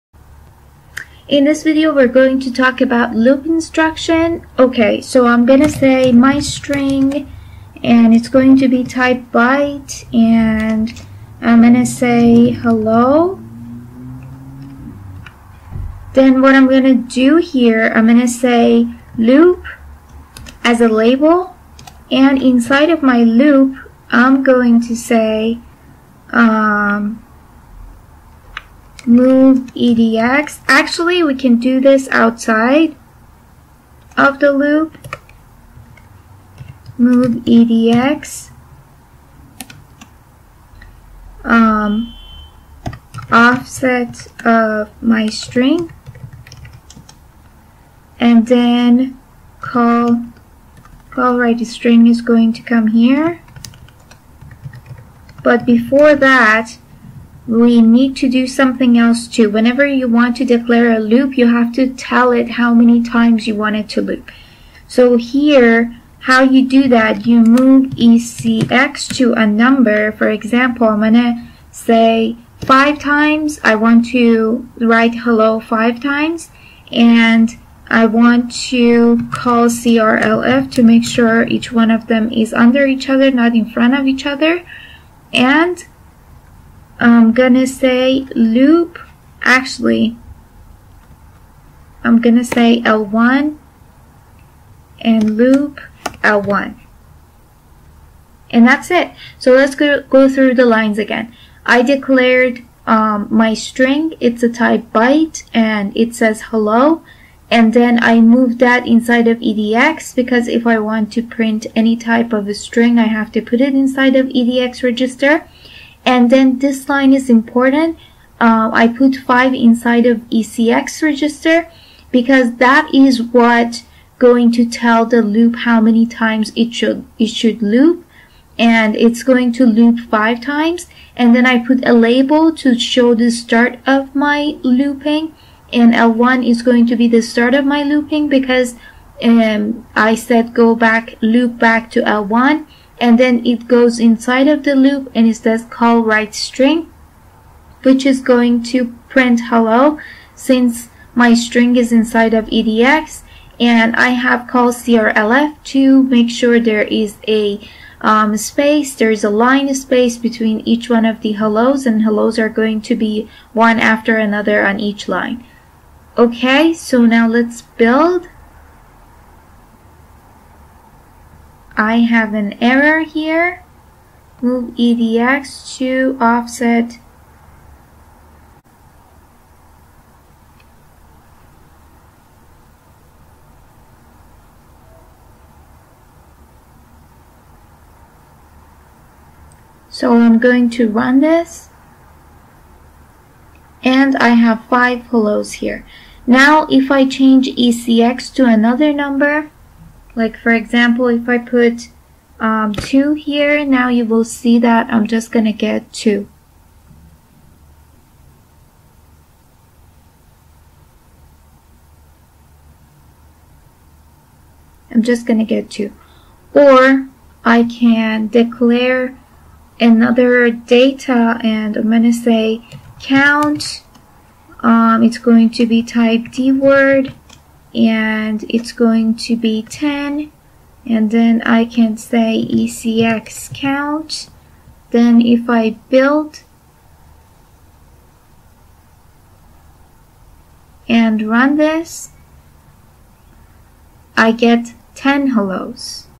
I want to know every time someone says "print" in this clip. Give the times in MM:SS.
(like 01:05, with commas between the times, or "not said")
01:51, 02:29.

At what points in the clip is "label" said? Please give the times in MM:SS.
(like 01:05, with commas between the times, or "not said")
00:20, 02:11.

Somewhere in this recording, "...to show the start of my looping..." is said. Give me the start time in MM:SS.
02:12.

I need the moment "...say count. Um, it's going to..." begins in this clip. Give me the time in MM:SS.
03:42.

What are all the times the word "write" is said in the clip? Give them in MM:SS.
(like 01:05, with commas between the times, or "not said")
00:51, 01:14, 02:26.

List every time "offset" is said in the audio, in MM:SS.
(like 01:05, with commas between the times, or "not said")
00:43, 02:56.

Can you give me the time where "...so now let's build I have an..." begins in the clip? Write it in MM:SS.
02:46.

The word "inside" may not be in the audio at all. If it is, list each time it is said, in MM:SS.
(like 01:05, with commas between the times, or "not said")
00:22, 01:48, 01:53, 01:59, 02:23, 02:31.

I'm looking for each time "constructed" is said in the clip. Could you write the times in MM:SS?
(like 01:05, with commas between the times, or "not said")
not said.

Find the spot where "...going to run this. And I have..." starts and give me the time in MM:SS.
03:10.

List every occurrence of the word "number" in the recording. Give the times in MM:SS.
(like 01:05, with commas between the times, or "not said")
01:09, 03:18.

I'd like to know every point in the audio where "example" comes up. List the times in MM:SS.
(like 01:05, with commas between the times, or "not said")
01:10, 03:20.